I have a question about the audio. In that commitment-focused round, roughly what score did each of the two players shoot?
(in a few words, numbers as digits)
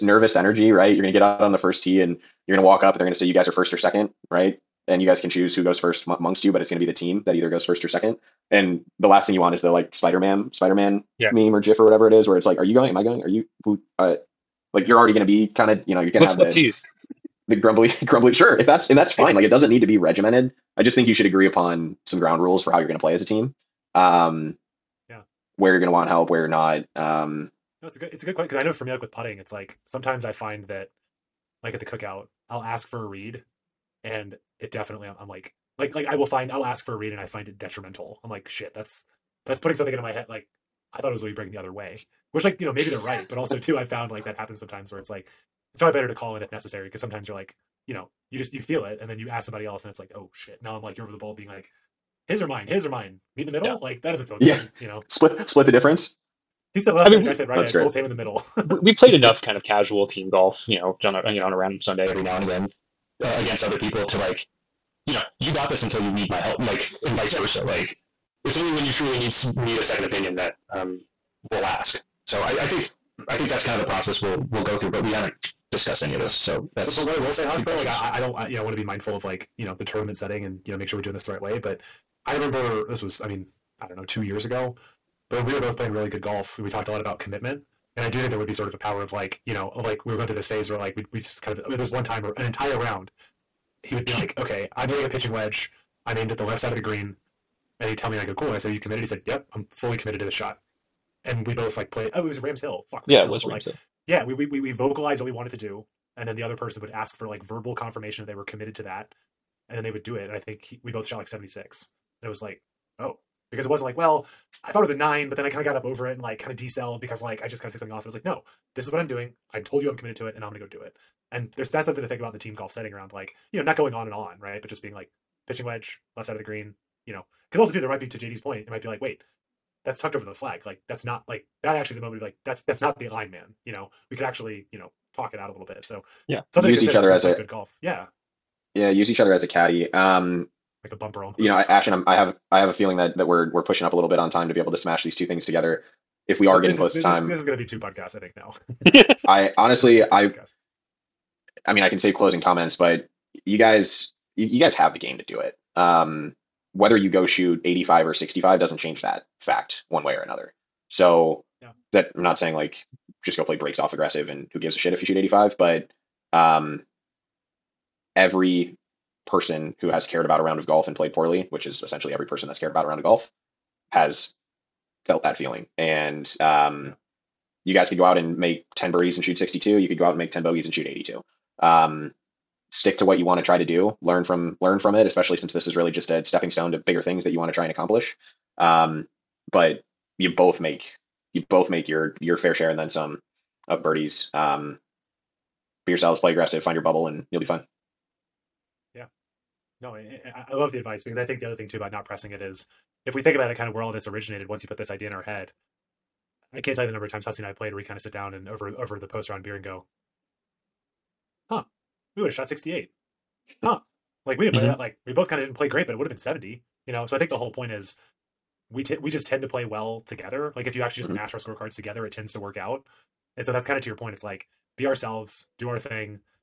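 76.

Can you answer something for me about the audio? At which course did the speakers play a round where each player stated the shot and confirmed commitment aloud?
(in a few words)
Rams Hill.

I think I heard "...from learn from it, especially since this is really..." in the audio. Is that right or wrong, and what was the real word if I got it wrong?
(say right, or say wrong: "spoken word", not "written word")
right.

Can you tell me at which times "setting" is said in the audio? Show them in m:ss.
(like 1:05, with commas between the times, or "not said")
1:20, 2:02.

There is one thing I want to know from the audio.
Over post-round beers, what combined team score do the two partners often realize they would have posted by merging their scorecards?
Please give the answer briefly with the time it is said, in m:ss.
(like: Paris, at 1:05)
68, at 3:32.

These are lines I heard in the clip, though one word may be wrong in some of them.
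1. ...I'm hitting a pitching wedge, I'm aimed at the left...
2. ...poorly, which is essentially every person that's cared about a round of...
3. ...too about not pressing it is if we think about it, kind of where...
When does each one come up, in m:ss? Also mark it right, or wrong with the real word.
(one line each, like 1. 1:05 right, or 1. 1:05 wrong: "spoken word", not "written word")
1. 1:34 right
2. 2:51 right
3. 3:21 right.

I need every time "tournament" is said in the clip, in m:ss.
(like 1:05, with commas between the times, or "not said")
1:19.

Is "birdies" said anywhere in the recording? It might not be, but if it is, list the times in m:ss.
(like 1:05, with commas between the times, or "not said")
2:58, 3:13.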